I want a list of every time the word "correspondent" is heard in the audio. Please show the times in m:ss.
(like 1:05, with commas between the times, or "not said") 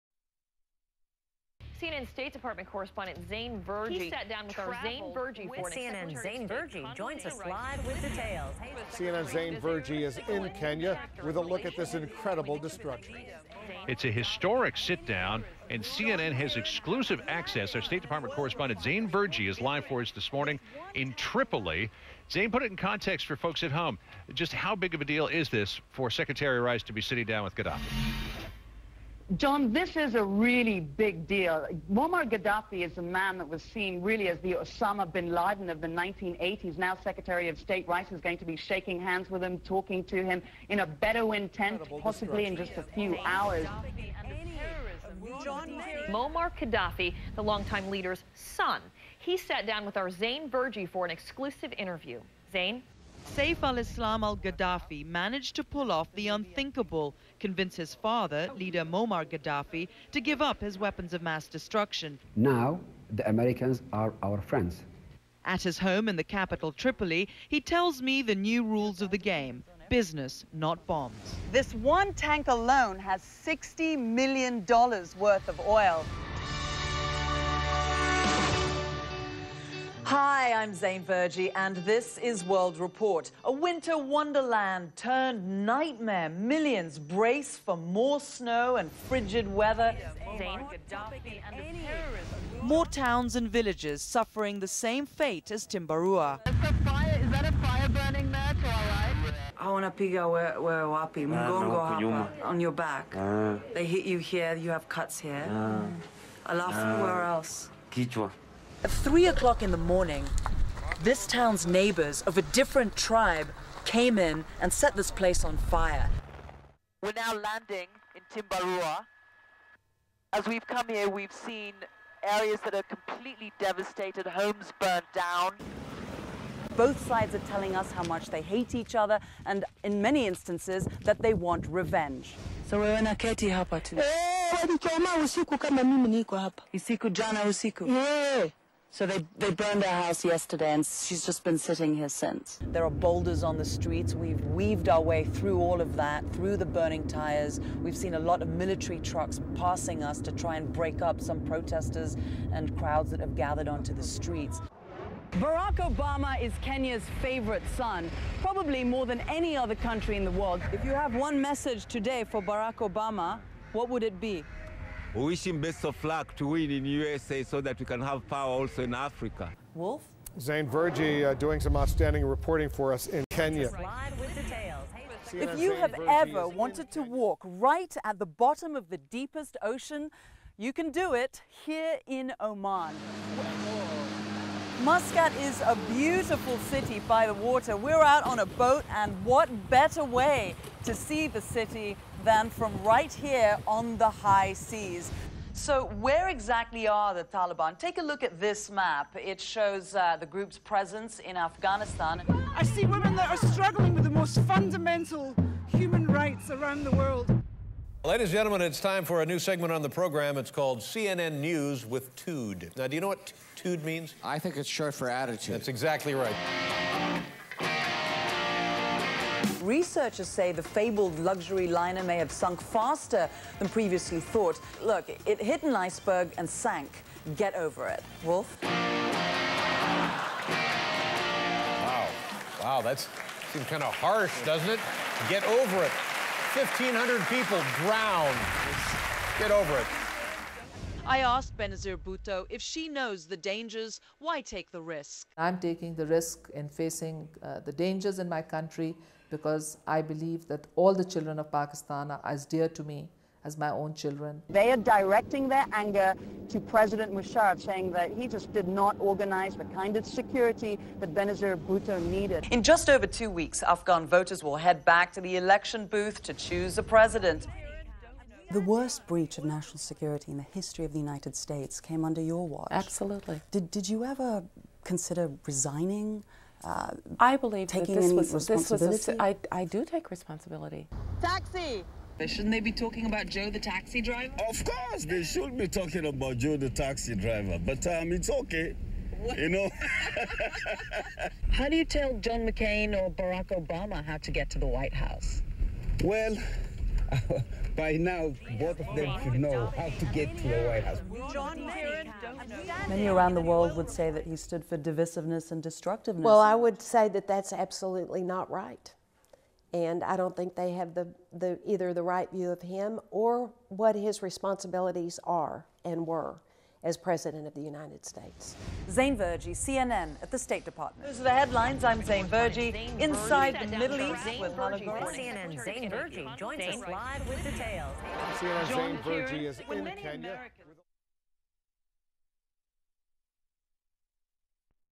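0:02, 0:18.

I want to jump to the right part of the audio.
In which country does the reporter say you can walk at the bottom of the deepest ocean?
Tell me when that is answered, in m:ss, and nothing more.
3:02.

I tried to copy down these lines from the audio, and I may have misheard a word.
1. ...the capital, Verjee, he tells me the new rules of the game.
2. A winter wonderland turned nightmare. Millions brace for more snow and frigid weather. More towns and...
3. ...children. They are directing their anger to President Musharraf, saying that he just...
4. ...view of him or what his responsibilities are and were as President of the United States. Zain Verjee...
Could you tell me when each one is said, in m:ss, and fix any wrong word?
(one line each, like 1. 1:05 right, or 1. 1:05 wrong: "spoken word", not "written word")
1. 1:06 wrong: "Tripoli", not "Verjee"
2. 1:23 right
3. 4:13 right
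4. 5:12 right.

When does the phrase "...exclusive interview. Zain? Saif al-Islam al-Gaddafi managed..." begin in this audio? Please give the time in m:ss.
0:51.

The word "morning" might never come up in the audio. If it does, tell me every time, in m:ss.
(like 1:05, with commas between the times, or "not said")
0:20, 1:49.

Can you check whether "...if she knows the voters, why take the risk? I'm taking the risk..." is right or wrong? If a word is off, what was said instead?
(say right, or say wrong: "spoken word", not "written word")
wrong: "dangers", not "voters".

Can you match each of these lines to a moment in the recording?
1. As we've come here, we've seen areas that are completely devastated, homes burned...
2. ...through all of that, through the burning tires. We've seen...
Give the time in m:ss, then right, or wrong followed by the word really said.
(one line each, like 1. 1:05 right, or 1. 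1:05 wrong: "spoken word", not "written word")
1. 2:00 right
2. 2:25 right.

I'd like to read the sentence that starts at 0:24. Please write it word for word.
Just how big of a deal is this for Secretary Rice to be sitting down with Gaddafi?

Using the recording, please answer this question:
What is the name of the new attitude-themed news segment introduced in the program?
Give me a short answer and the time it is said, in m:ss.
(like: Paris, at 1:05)
CNN News with Tood, at 3:30.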